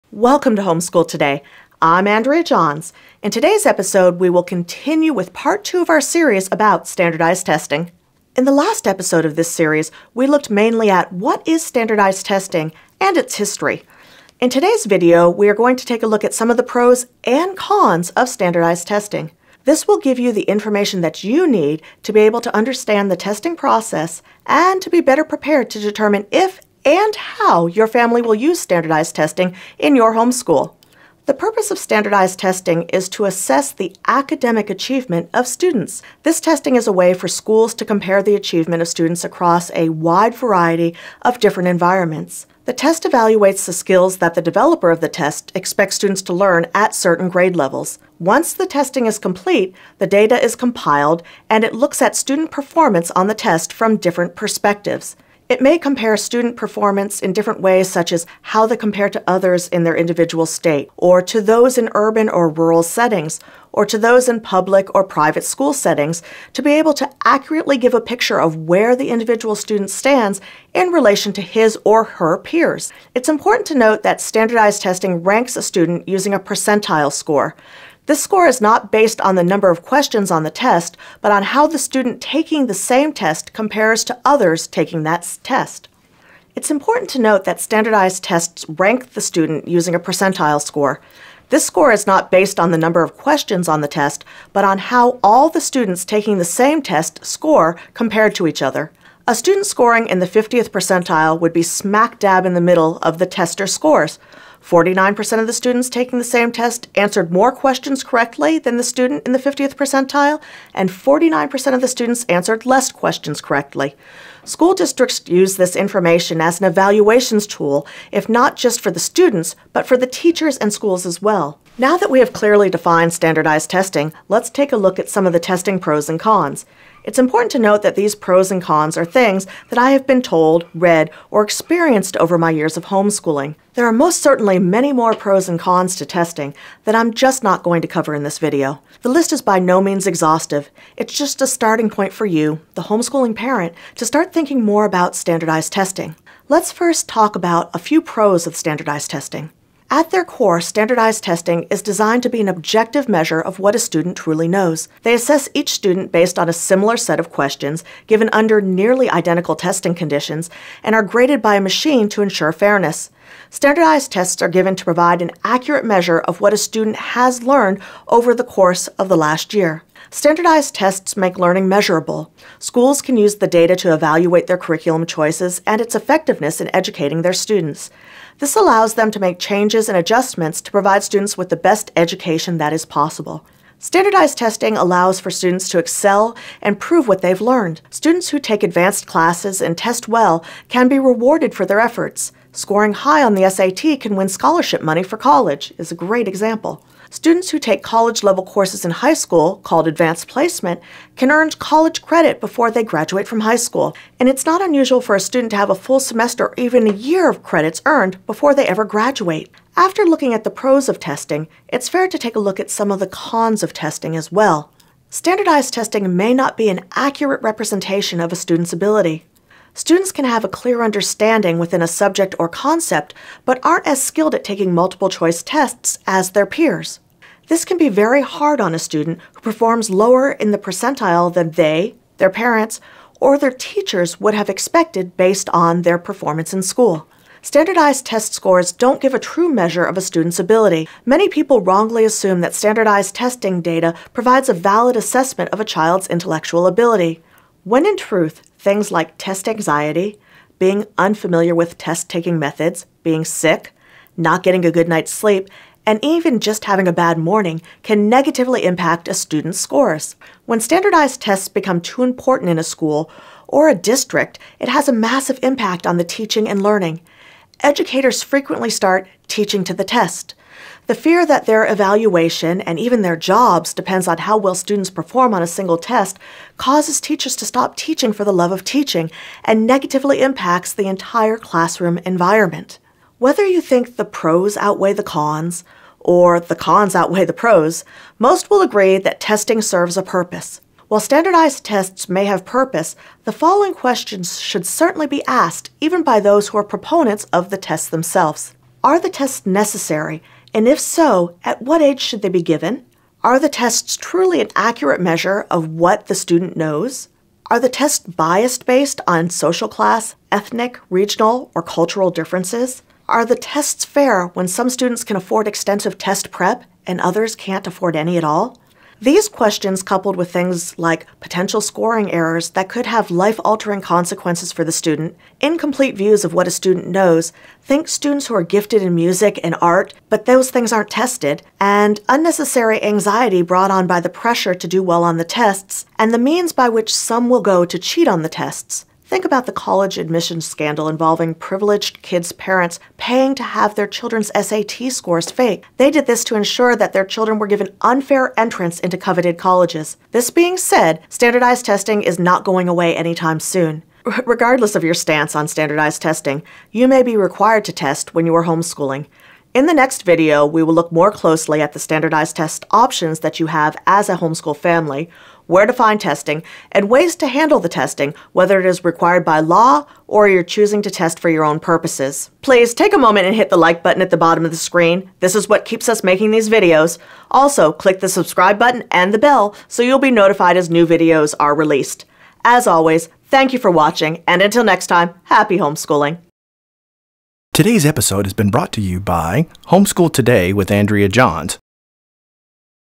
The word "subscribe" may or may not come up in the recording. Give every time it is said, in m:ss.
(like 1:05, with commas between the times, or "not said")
6:18.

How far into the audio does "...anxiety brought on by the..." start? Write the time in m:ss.
5:32.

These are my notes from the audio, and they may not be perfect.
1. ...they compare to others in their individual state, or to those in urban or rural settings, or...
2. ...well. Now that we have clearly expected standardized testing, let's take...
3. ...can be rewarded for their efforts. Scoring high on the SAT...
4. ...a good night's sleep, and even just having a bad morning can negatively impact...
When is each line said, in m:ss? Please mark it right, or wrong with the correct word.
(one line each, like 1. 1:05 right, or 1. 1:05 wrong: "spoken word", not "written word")
1. 0:58 right
2. 2:01 wrong: "defined", not "expected"
3. 3:10 right
4. 4:14 right.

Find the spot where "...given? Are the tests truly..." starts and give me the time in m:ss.
5:02.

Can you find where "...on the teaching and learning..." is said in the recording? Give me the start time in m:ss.
4:25.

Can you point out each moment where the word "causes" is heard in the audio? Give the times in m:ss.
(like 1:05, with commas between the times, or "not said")
4:36.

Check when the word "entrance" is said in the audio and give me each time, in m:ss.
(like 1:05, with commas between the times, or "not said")
5:48.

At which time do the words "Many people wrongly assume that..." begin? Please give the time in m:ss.
4:01.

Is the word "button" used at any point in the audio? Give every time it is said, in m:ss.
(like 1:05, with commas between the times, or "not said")
6:13, 6:18.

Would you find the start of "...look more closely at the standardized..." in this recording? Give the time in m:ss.
6:00.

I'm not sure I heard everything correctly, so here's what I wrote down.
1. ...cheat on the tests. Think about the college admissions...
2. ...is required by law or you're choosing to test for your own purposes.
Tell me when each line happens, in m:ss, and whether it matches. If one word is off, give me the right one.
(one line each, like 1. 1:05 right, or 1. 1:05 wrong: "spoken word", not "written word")
1. 5:37 right
2. 6:08 right.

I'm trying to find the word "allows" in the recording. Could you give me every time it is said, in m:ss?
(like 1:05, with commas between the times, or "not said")
2:58, 3:04.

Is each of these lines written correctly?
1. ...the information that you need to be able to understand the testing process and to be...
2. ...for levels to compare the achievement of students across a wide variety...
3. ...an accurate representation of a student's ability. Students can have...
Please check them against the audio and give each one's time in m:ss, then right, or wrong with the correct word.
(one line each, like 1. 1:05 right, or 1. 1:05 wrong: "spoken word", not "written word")
1. 0:20 right
2. 0:37 wrong: "schools", not "levels"
3. 3:36 right.